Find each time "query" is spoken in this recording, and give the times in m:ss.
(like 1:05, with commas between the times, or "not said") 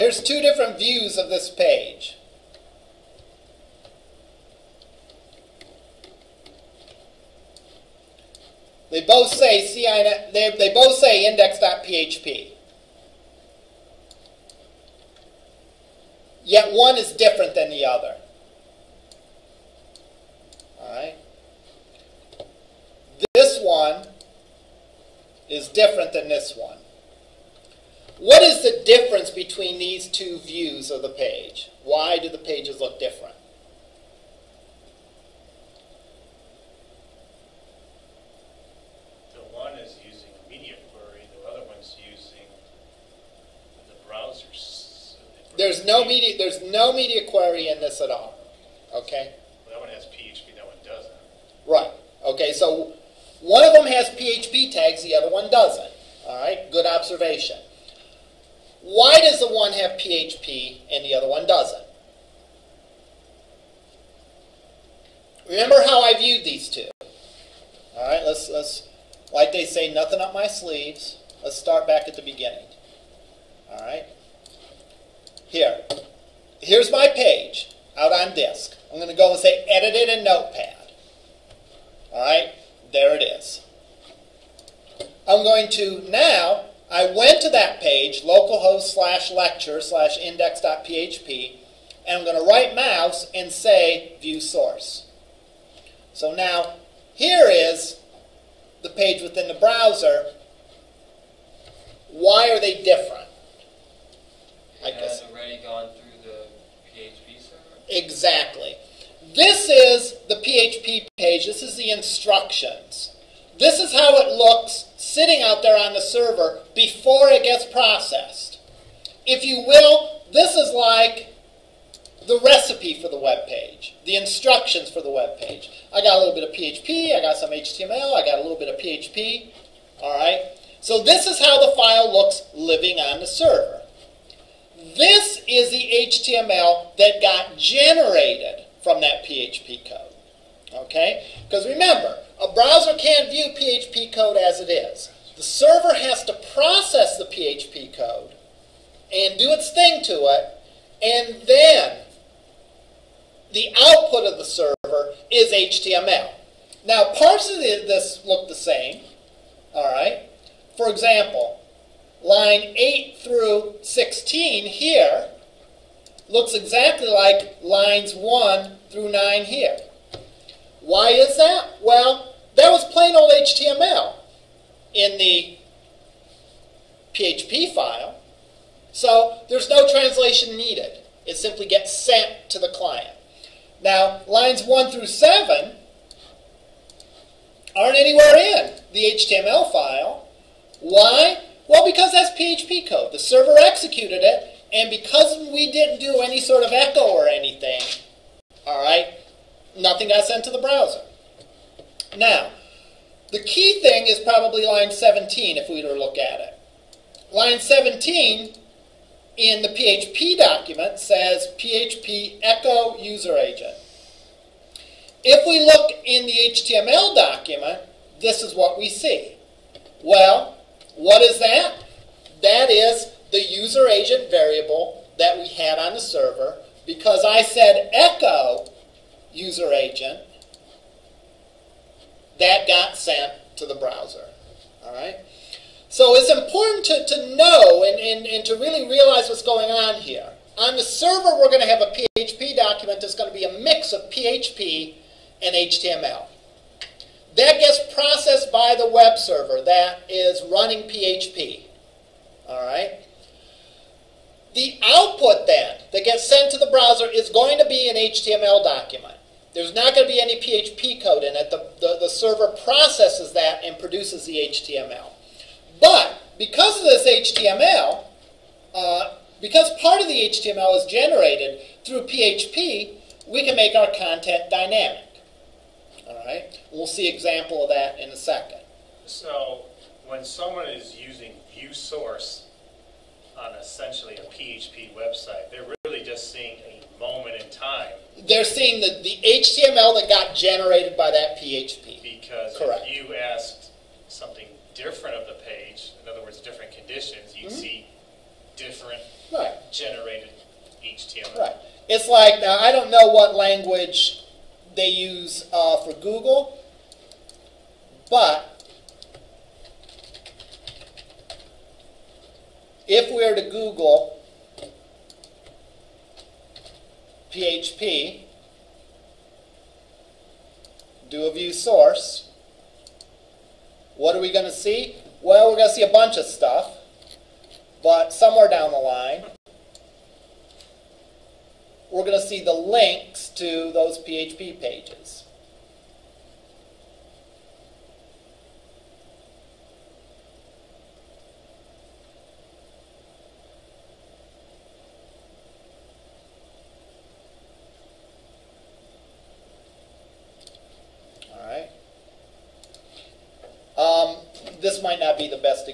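0:40, 0:47.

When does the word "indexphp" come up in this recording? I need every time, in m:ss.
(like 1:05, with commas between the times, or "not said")
0:11, 1:30.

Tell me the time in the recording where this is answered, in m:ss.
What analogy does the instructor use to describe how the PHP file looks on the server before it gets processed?
2:02.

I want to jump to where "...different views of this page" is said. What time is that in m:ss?
0:00.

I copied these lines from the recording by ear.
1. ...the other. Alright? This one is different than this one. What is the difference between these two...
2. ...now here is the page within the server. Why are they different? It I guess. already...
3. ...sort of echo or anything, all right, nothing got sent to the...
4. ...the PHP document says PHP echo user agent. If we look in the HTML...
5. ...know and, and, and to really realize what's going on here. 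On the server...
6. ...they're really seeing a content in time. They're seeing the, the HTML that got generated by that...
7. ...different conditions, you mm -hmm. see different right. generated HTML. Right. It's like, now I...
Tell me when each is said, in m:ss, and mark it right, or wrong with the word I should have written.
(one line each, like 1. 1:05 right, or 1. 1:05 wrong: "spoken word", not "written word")
1. 0:17 right
2. 1:36 wrong: "browser", not "server"
3. 3:16 right
4. 3:29 right
5. 3:57 right
6. 4:45 wrong: "moment", not "content"
7. 4:56 right.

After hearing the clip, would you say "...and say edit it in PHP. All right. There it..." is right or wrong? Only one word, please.
wrong.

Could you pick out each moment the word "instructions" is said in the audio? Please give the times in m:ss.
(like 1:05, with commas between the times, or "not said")
1:51, 2:04.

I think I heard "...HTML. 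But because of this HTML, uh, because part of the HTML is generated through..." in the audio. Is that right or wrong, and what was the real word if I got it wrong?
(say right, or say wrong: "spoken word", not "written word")
right.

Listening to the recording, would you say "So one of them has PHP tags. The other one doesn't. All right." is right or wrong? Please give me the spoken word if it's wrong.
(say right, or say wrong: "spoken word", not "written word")
right.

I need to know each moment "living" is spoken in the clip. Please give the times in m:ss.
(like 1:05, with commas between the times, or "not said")
2:12.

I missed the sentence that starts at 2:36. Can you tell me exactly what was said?
Now, parts of this look the same, all right?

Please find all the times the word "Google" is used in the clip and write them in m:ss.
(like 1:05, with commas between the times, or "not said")
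5:06, 5:13.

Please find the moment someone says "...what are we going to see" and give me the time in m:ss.
5:23.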